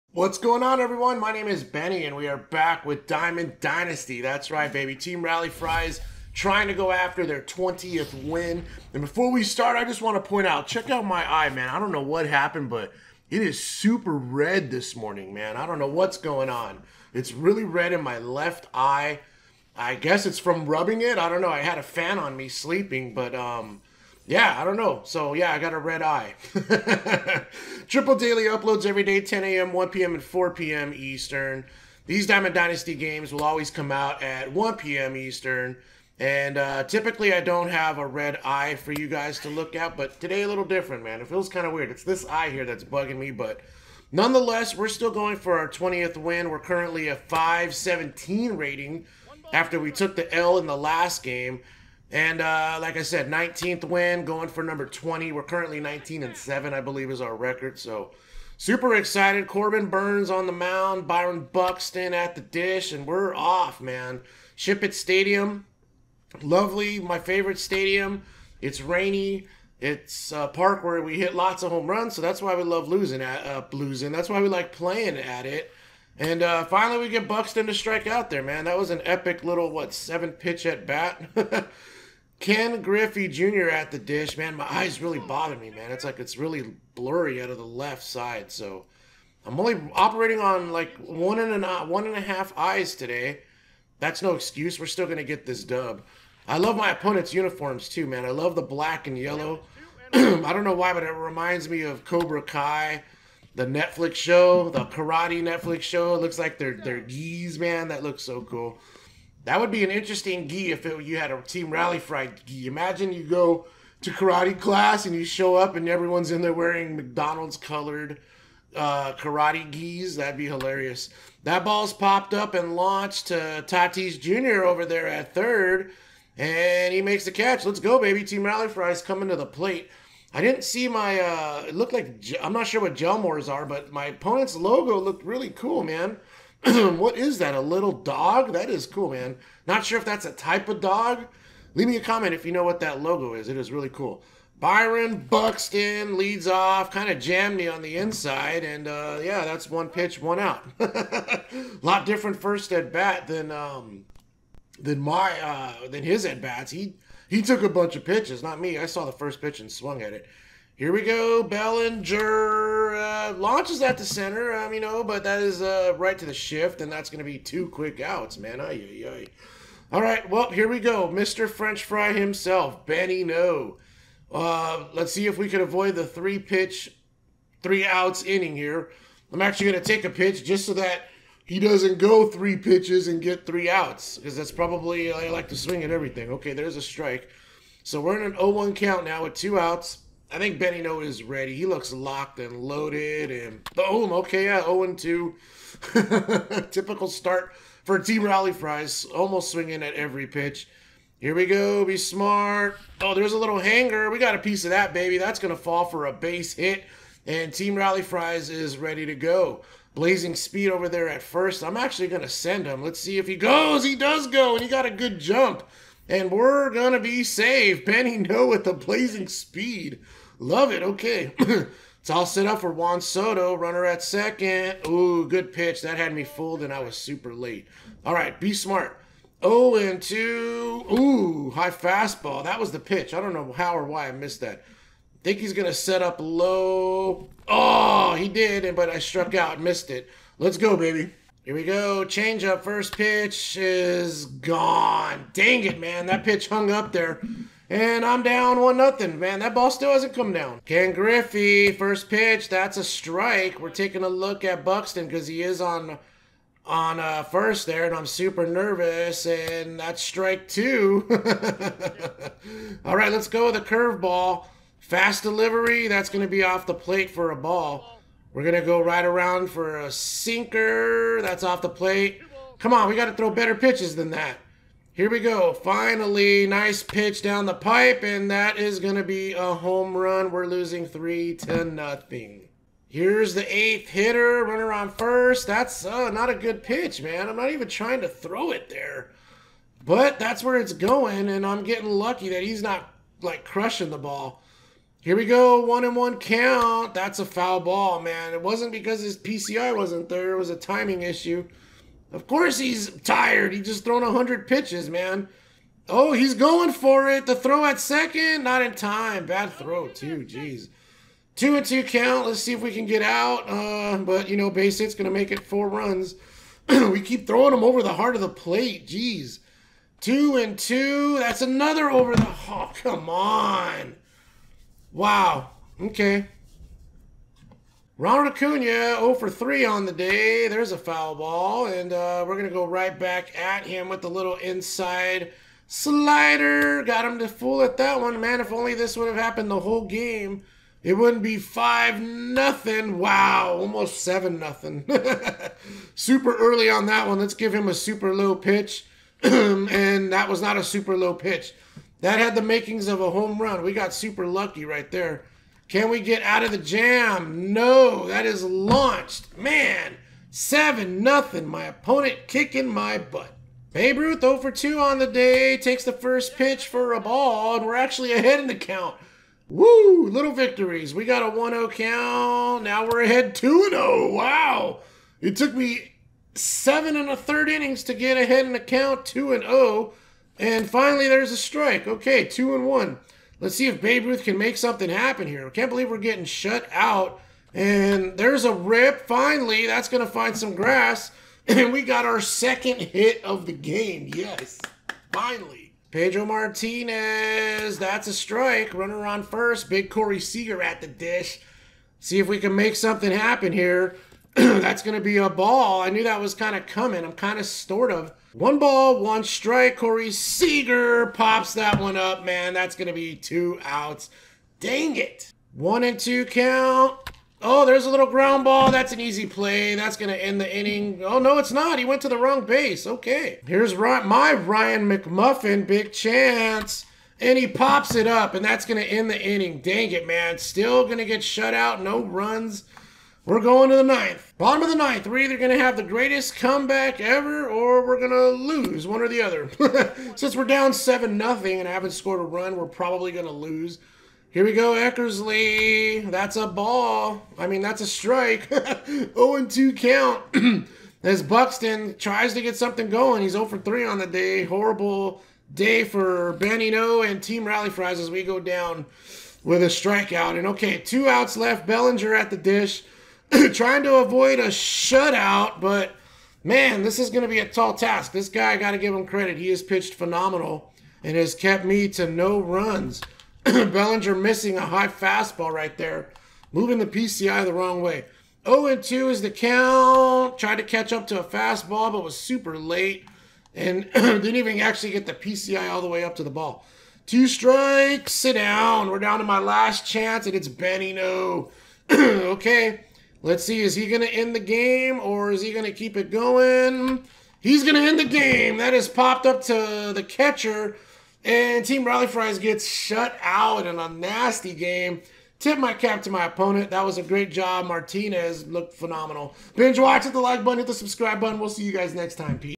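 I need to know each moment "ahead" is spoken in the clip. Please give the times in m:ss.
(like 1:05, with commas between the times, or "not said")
6:08, 6:13, 6:18.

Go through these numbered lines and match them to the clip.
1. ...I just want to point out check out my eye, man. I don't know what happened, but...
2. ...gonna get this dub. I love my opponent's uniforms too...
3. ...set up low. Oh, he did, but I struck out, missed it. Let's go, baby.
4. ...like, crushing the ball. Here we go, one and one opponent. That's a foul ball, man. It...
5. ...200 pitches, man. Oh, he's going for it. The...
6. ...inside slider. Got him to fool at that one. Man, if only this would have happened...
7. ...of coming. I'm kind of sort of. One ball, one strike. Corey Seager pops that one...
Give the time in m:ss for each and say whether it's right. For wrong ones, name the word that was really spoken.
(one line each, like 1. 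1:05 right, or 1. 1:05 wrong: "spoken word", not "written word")
1. 0:09 right
2. 1:35 right
3. 3:55 right
4. 4:53 wrong: "count", not "opponent"
5. 5:04 wrong: "100", not "200"
6. 5:34 right
7. 6:46 right.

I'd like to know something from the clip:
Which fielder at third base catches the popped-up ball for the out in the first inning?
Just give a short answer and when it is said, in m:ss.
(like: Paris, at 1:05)
Tatis Jr., at 2:03.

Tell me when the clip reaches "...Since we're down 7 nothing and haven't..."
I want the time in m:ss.
7:20.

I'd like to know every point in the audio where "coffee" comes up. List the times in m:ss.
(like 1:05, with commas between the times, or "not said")
not said.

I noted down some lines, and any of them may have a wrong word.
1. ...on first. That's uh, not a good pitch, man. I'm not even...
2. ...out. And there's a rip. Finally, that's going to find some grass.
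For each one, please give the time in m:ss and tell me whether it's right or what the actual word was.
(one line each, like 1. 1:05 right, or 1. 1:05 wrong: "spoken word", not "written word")
1. 4:44 right
2. 6:26 right.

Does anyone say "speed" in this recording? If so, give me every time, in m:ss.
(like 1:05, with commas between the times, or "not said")
3:30, 3:39.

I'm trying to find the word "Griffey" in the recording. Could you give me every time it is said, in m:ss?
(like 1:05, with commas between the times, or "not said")
1:22, 4:10.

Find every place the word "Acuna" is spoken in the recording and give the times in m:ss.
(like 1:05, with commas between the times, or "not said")
5:28.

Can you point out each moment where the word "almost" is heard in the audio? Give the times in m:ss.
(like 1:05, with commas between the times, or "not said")
3:19, 5:43.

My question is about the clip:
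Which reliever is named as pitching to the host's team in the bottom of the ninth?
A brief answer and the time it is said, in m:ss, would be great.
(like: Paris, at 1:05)
Eckersley, at 7:24.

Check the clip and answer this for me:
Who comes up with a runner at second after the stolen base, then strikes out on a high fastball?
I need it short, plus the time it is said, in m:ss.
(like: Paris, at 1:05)
Juan Soto, at 3:42.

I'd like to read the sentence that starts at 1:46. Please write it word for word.
It looks like they're they're geese, man.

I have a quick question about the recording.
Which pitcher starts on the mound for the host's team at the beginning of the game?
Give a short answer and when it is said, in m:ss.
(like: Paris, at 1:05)
Corbin Burnes, at 0:59.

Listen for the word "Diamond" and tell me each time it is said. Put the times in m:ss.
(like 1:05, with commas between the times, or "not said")
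0:03, 0:32.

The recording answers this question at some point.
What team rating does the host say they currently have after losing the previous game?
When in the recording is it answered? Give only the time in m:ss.
0:47.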